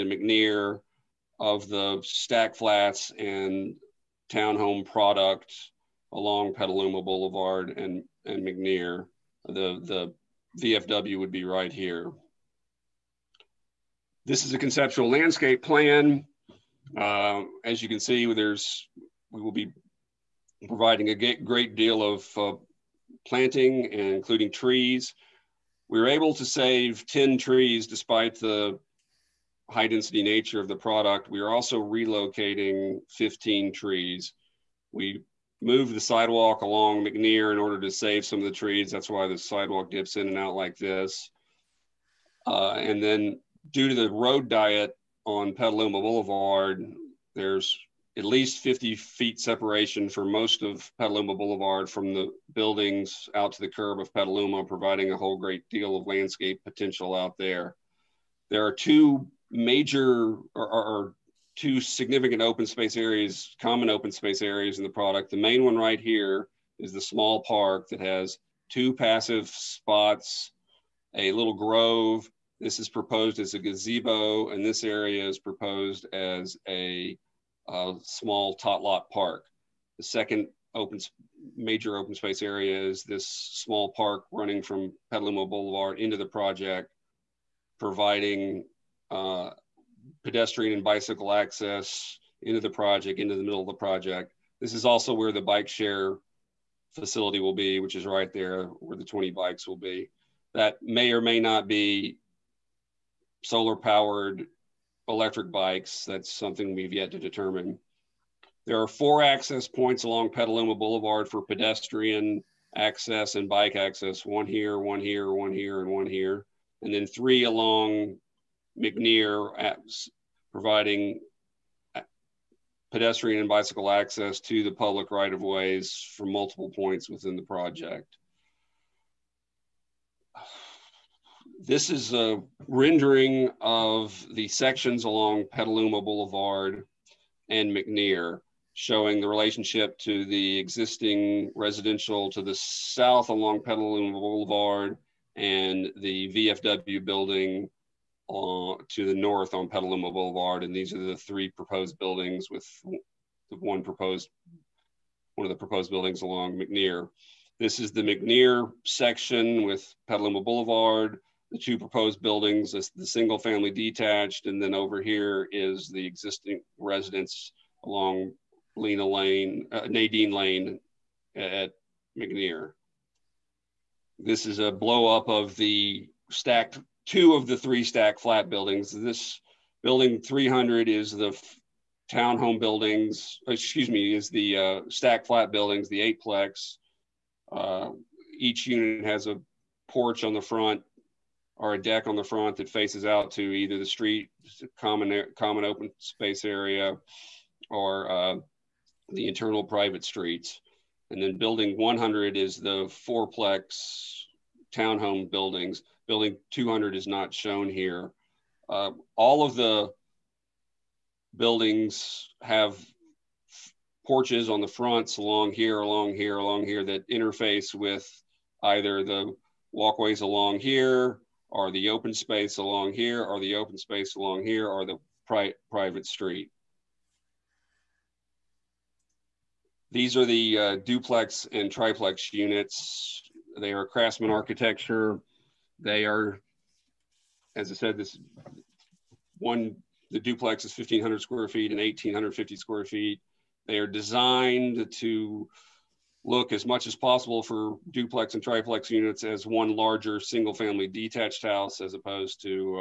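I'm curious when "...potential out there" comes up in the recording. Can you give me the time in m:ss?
0:56.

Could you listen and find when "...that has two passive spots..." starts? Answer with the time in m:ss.
1:07.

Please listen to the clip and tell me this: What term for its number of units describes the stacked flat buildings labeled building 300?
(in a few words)
eightplex.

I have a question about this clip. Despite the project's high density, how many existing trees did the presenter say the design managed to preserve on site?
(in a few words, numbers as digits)
10.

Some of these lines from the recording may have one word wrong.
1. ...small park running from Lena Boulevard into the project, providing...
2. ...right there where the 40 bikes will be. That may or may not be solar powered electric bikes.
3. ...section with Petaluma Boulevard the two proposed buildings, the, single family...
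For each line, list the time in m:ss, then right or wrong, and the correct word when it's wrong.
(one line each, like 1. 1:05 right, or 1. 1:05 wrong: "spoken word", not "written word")
1. 1:23 wrong: "Petaluma", not "Lena"
2. 1:38 wrong: "20", not "40"
3. 2:38 right.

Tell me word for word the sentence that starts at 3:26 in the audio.
Building 200 is not shown here.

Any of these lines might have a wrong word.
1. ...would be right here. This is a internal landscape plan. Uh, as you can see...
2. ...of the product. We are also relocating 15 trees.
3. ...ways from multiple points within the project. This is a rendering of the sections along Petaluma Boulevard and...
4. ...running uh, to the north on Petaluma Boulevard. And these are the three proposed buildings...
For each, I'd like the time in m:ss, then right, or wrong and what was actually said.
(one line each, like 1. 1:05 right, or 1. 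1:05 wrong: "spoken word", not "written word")
1. 0:11 wrong: "conceptual", not "internal"
2. 0:30 right
3. 2:05 right
4. 2:27 wrong: "building", not "running".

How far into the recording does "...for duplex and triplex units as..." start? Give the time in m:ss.
4:07.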